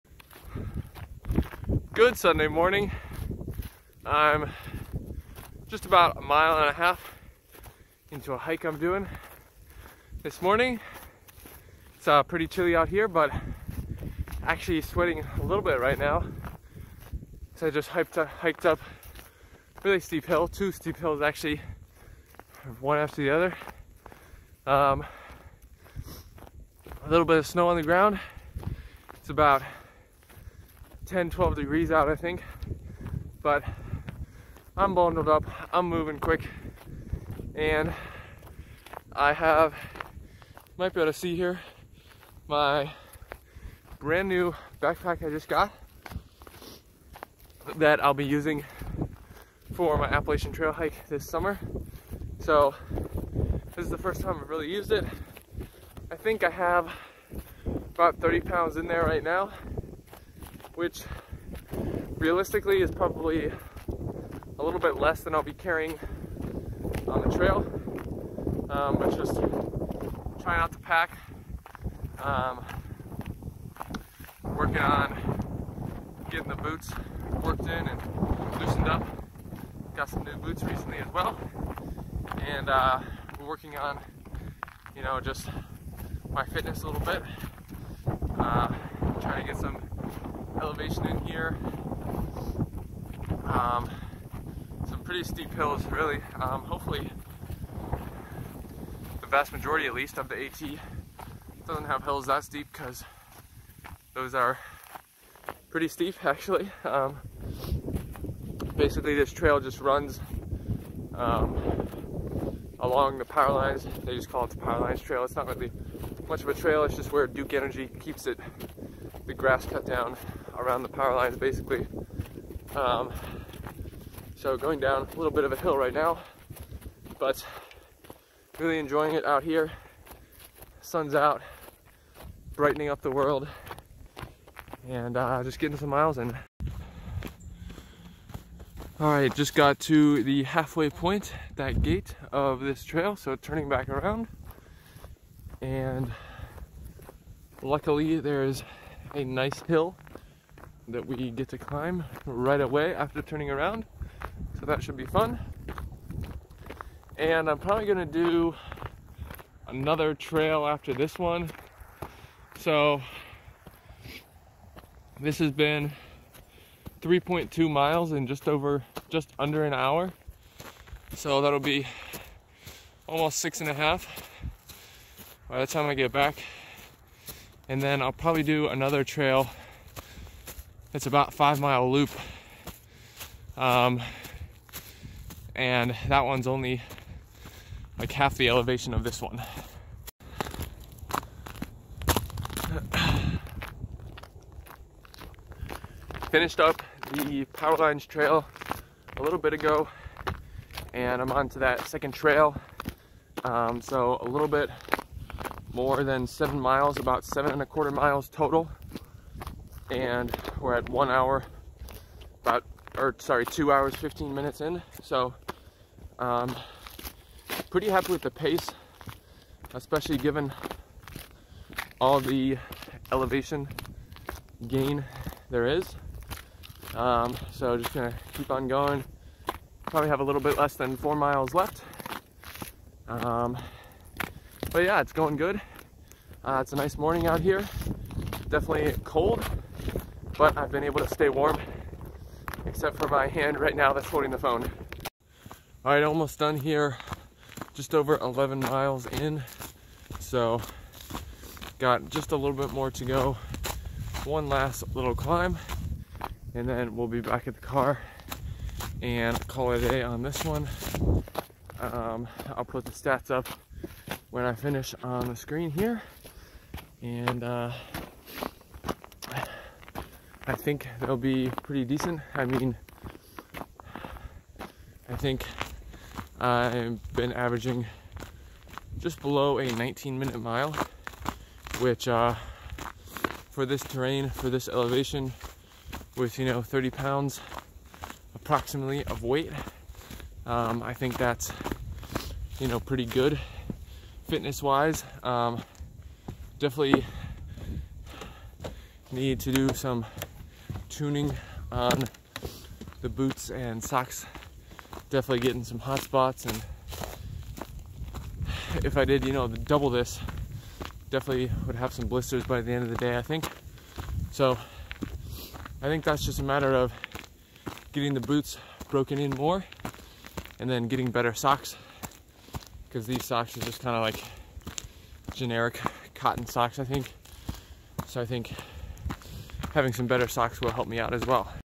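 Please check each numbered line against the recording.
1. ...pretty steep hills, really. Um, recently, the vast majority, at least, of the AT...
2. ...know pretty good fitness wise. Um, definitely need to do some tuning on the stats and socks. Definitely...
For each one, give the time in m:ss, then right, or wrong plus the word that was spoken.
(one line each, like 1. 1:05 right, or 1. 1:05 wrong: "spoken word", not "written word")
1. 1:35 wrong: "hopefully", not "recently"
2. 4:52 wrong: "boots", not "stats".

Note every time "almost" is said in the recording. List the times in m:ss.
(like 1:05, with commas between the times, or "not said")
2:53, 4:06.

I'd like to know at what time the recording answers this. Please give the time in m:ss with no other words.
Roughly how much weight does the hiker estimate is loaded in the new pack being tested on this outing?
0:57.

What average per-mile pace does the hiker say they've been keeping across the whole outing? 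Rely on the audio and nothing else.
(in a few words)
just below 19 minutes.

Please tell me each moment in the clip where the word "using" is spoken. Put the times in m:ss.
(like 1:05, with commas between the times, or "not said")
0:48.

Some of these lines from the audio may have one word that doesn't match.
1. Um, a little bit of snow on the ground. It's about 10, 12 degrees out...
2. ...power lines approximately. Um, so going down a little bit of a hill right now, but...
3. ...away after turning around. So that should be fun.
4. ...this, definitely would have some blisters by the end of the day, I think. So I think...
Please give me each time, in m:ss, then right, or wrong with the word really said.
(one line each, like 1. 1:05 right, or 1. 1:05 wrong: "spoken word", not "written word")
1. 0:24 right
2. 2:00 wrong: "basically", not "approximately"
3. 2:32 right
4. 5:09 right.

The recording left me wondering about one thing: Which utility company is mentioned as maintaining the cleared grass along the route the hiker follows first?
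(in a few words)
Duke Energy.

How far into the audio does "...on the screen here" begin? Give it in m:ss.
4:25.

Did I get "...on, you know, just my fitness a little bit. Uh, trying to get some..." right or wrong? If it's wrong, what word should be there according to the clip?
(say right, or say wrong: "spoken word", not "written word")
right.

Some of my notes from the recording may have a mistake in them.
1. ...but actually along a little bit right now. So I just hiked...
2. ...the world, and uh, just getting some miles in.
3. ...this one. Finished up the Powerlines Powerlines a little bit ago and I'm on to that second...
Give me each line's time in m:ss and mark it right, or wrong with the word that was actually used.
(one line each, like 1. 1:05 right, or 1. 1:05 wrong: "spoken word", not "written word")
1. 0:13 wrong: "sweating", not "along"
2. 2:13 right
3. 3:09 wrong: "Trail", not "Powerlines".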